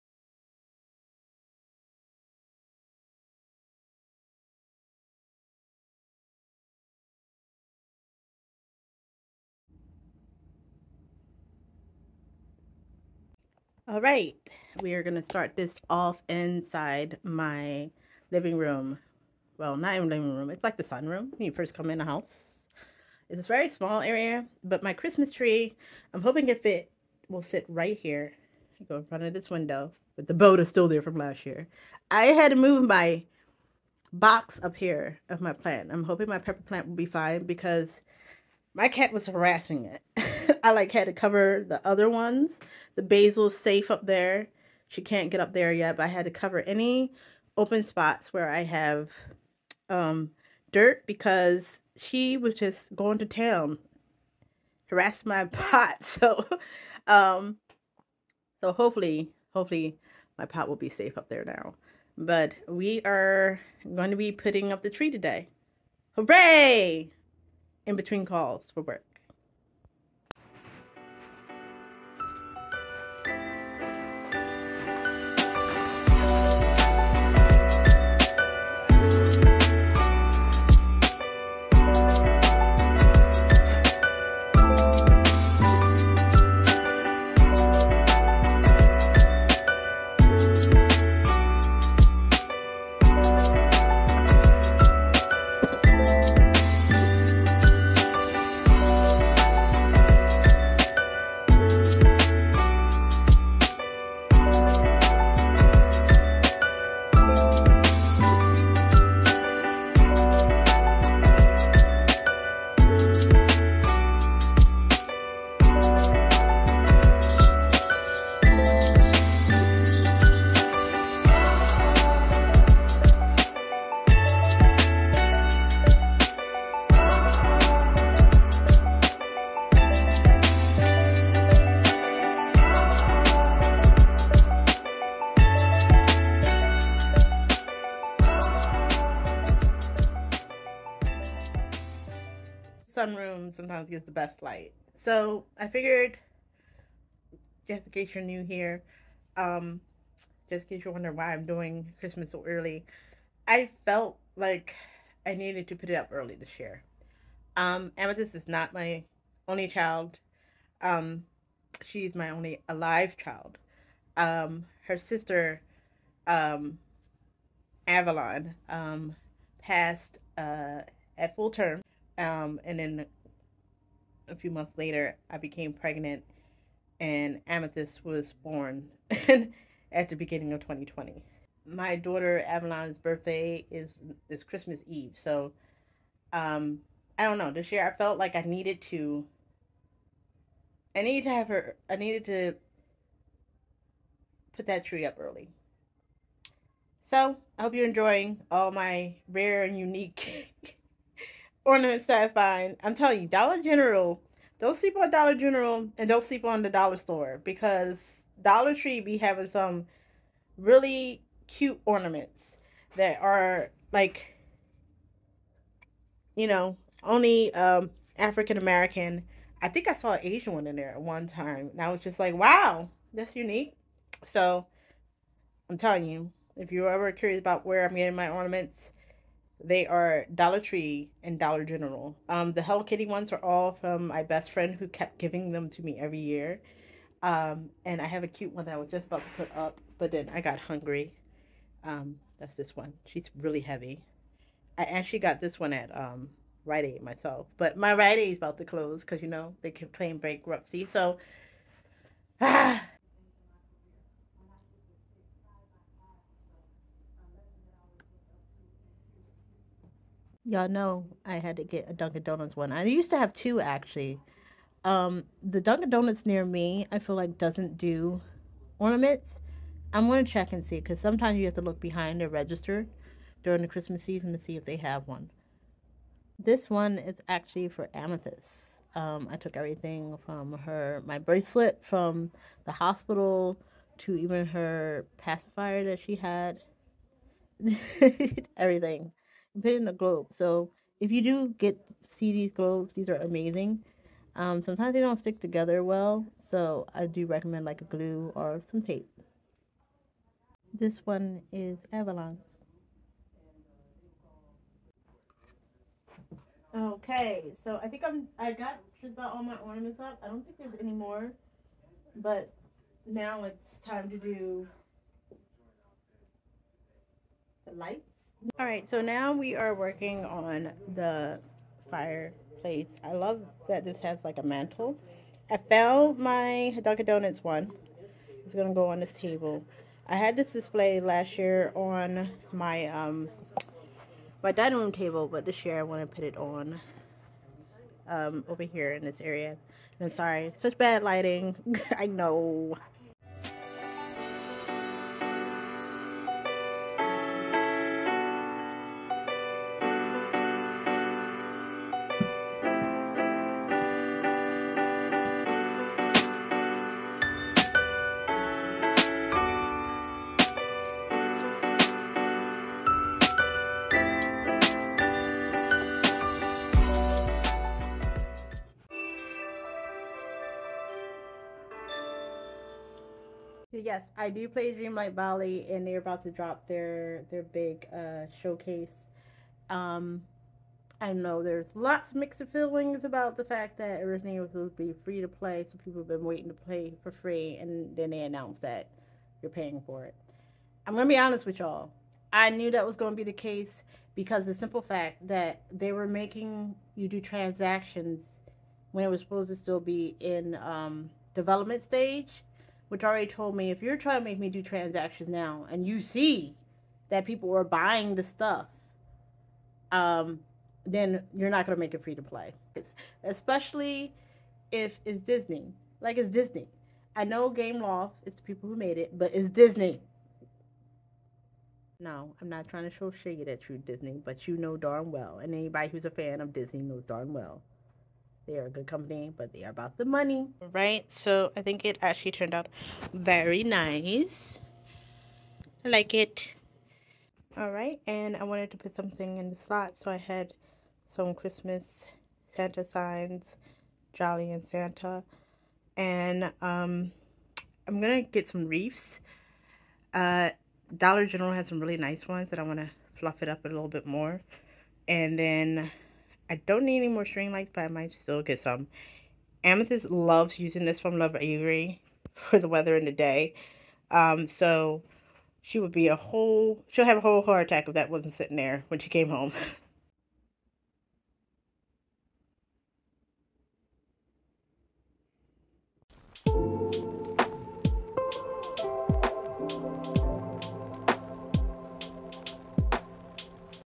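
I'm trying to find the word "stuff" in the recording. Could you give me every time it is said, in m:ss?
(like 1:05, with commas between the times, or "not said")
6:48.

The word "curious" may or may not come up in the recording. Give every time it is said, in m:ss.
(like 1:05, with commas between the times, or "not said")
3:47.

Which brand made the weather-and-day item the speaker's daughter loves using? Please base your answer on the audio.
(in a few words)
Lovevery.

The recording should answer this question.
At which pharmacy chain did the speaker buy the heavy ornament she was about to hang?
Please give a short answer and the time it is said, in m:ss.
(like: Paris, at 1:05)
Rite Aid, at 4:06.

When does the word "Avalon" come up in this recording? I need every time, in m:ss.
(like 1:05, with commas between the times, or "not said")
2:47, 3:02, 5:01.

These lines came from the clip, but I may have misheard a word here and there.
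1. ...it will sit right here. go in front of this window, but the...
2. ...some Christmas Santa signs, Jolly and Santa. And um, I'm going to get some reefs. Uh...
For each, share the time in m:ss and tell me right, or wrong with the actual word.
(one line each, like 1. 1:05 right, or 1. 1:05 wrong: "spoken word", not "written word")
1. 0:26 right
2. 7:21 right.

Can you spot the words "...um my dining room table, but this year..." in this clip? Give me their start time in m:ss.
5:32.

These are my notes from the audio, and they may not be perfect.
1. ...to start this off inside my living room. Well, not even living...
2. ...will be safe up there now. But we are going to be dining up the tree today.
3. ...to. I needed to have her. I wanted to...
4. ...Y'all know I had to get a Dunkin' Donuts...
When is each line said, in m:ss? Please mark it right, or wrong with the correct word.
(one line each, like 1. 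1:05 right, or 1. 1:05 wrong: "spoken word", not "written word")
1. 0:15 right
2. 1:00 wrong: "putting", not "dining"
3. 3:08 wrong: "needed", not "wanted"
4. 4:20 right.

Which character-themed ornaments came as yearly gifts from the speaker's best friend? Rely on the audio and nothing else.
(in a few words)
Hello Kitty.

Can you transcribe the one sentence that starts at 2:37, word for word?
Um, Amethyst is not my only child.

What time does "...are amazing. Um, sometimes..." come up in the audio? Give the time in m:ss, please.
4:53.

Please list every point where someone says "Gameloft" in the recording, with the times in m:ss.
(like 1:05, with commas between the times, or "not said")
6:57.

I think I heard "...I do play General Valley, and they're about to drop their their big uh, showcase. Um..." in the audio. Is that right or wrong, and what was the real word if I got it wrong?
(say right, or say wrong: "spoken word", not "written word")
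wrong: "Dreamlight", not "General".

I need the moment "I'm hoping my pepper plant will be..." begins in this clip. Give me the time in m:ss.
0:35.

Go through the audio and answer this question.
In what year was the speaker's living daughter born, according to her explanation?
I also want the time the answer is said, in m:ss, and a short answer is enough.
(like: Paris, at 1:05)
2020, at 3:00.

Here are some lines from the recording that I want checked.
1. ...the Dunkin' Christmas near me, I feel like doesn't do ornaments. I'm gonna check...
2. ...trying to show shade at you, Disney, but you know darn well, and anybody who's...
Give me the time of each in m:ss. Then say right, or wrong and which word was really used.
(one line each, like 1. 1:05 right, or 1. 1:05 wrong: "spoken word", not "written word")
1. 4:25 wrong: "Donuts", not "Christmas"
2. 7:02 right.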